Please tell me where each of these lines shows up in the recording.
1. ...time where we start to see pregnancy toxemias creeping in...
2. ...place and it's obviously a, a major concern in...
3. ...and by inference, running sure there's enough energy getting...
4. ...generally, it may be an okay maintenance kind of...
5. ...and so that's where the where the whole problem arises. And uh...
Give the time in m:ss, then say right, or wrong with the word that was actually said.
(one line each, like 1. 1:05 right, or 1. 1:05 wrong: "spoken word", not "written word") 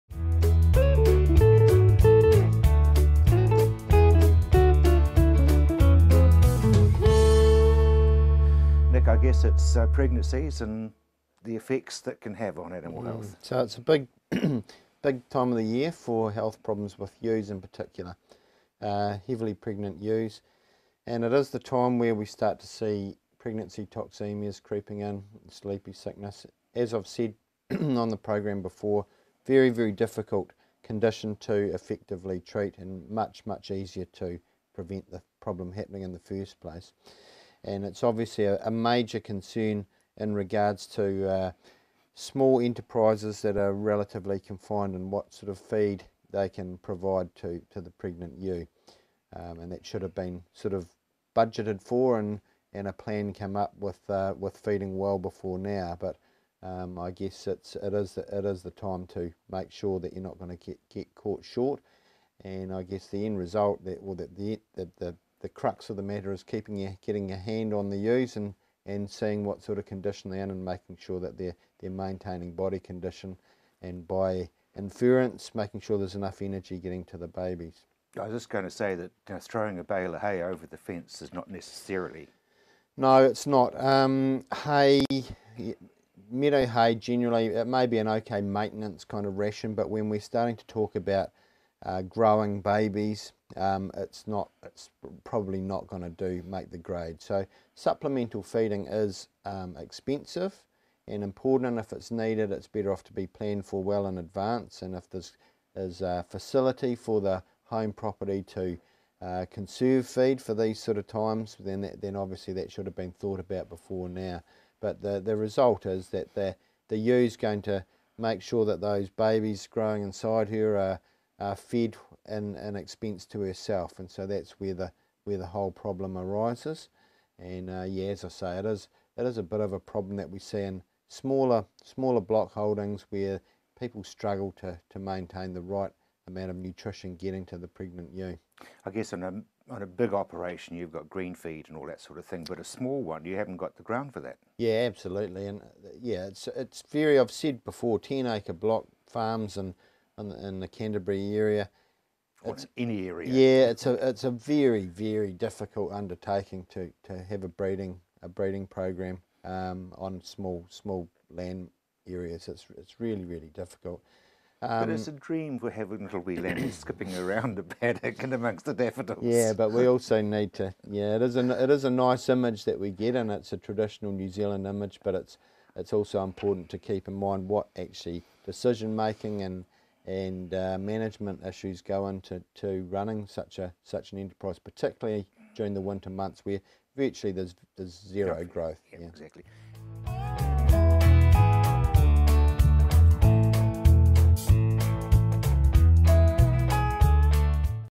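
1. 0:21 right
2. 0:36 right
3. 1:13 wrong: "making", not "running"
4. 1:26 right
5. 2:03 right.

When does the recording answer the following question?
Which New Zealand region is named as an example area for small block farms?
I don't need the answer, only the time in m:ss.
2:30.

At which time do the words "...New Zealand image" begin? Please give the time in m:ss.
2:54.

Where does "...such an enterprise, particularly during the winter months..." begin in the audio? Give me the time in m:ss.
3:03.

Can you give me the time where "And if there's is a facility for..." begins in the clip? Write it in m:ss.
1:44.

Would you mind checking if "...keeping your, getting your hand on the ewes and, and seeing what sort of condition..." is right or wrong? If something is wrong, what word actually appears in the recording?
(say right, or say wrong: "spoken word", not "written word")
right.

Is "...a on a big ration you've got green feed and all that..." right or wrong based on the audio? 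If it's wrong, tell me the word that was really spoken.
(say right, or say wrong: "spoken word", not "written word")
wrong: "operation", not "ration".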